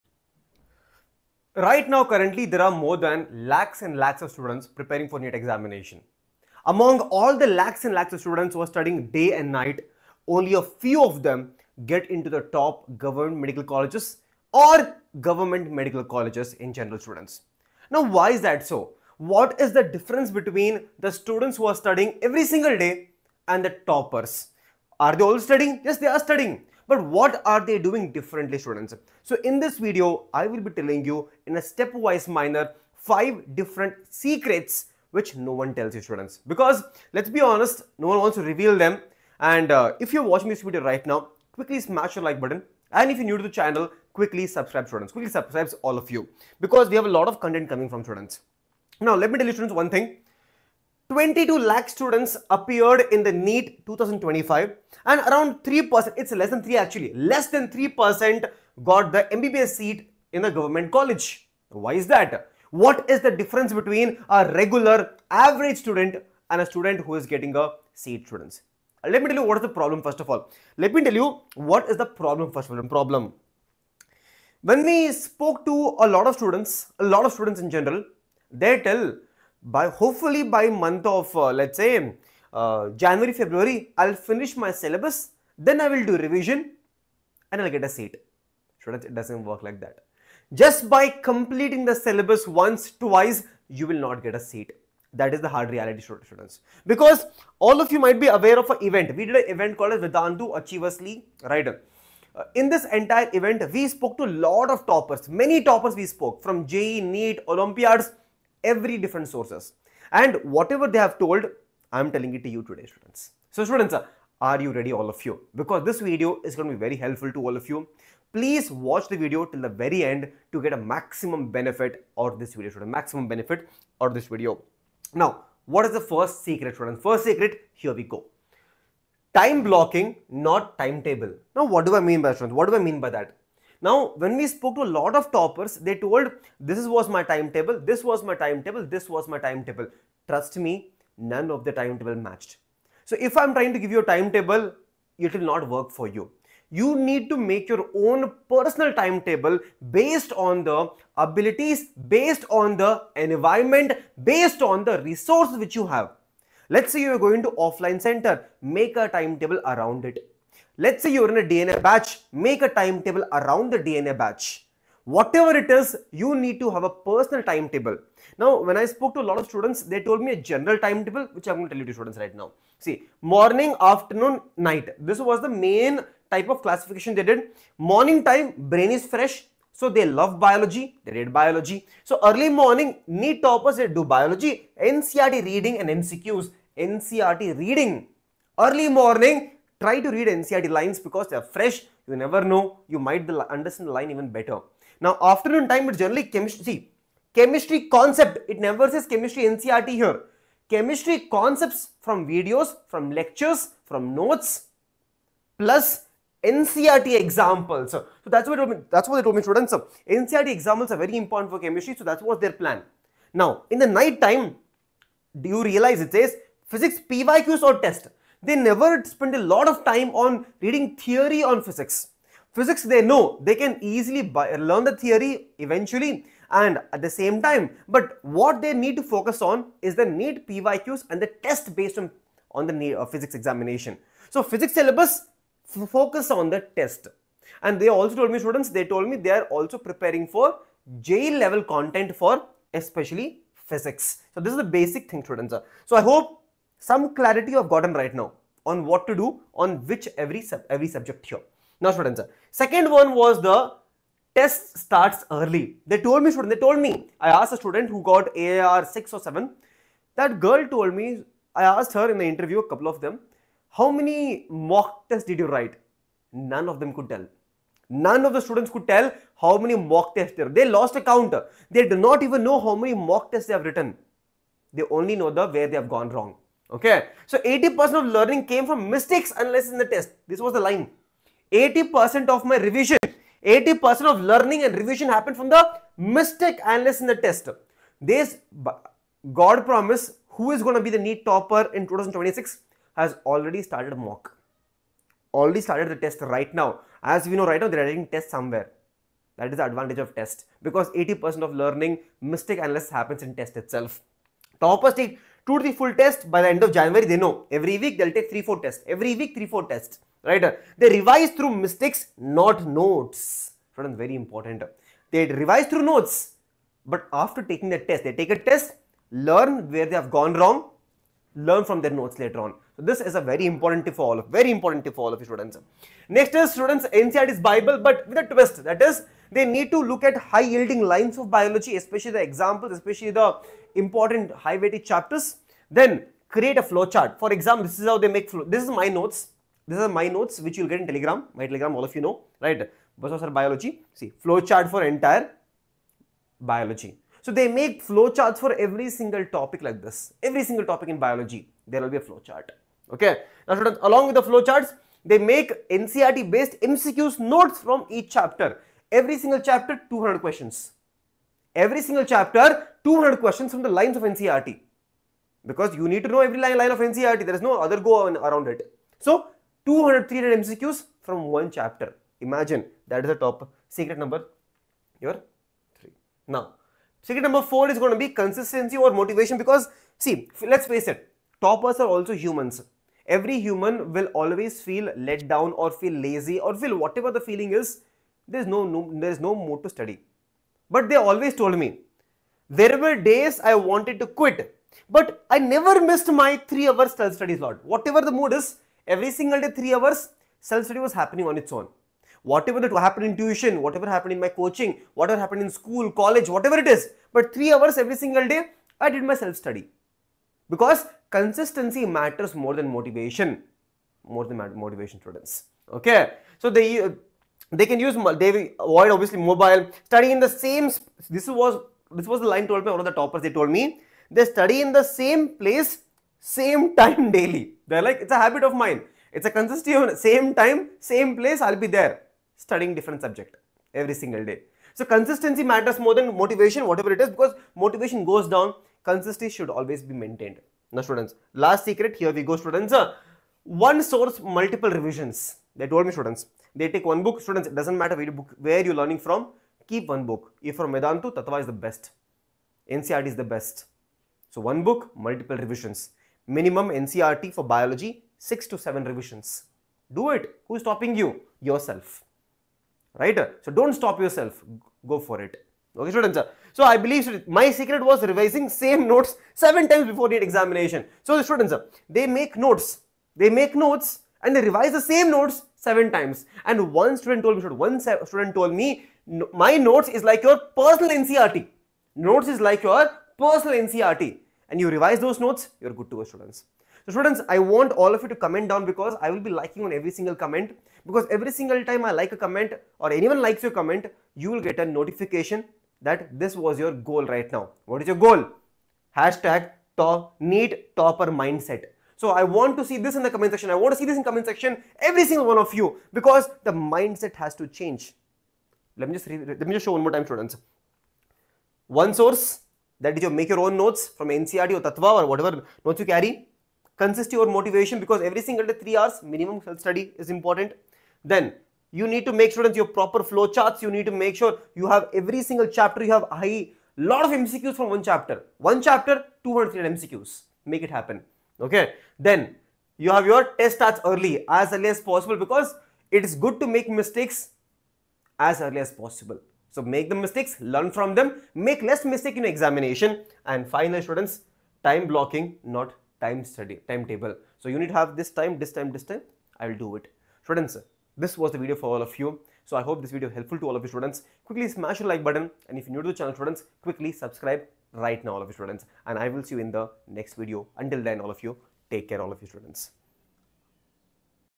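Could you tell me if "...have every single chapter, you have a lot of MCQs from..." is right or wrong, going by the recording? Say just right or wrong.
right.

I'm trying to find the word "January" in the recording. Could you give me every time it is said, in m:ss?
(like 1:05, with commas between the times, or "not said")
1:22, 5:06.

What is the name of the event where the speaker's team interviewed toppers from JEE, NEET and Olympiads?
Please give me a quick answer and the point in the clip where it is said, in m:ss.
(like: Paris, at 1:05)
Vedantu Achievers League, at 1:40.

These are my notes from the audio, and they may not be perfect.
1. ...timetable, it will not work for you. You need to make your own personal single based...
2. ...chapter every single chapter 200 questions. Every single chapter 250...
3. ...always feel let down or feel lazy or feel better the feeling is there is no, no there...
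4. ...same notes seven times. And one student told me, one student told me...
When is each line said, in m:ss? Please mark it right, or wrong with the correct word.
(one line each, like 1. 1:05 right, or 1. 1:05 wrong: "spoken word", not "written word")
1. 2:24 wrong: "timetable", not "single"
2. 5:58 wrong: "200", not "250"
3. 6:24 wrong: "whatever", not "better"
4. 7:54 right.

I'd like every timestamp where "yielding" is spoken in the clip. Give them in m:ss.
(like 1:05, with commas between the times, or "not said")
5:30.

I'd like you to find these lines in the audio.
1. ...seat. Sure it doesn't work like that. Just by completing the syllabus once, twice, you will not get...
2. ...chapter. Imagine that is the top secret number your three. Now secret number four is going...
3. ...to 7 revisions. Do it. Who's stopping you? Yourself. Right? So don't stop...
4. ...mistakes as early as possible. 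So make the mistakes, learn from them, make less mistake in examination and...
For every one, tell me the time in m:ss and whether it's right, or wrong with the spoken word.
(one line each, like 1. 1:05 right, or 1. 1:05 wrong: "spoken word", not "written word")
1. 1:27 right
2. 6:11 right
3. 7:38 right
4. 8:56 right.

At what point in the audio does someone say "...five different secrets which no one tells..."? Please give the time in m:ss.
0:32.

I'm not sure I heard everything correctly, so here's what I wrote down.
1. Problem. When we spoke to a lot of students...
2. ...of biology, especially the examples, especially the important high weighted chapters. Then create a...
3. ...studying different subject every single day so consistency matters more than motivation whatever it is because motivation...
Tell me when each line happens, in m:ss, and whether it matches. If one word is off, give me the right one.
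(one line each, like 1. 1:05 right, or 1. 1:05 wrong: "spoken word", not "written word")
1. 1:12 right
2. 5:31 right
3. 7:12 right.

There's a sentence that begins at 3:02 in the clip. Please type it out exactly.
So early morning, NEET toppers, they do biology, NCRT reading and MCQs, NCRT reading.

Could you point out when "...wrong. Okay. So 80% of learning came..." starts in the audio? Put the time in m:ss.
4:36.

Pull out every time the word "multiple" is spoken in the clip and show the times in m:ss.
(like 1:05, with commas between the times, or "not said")
7:24, 7:34.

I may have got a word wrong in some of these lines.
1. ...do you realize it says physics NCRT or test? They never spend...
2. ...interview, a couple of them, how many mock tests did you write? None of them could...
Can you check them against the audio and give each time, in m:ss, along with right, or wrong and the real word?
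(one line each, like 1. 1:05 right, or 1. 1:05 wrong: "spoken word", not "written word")
1. 3:35 wrong: "PYQs", not "NCRT"
2. 4:22 right.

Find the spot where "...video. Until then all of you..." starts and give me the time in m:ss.
9:20.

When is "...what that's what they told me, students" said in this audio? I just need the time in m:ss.
3:28.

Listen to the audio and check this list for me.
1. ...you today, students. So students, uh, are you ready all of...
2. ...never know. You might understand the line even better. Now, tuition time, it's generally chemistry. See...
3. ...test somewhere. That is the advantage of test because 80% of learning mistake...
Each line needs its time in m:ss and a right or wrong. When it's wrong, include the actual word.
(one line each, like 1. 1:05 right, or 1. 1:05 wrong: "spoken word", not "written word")
1. 1:52 right
2. 3:12 wrong: "afternoon", not "tuition"
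3. 4:58 right.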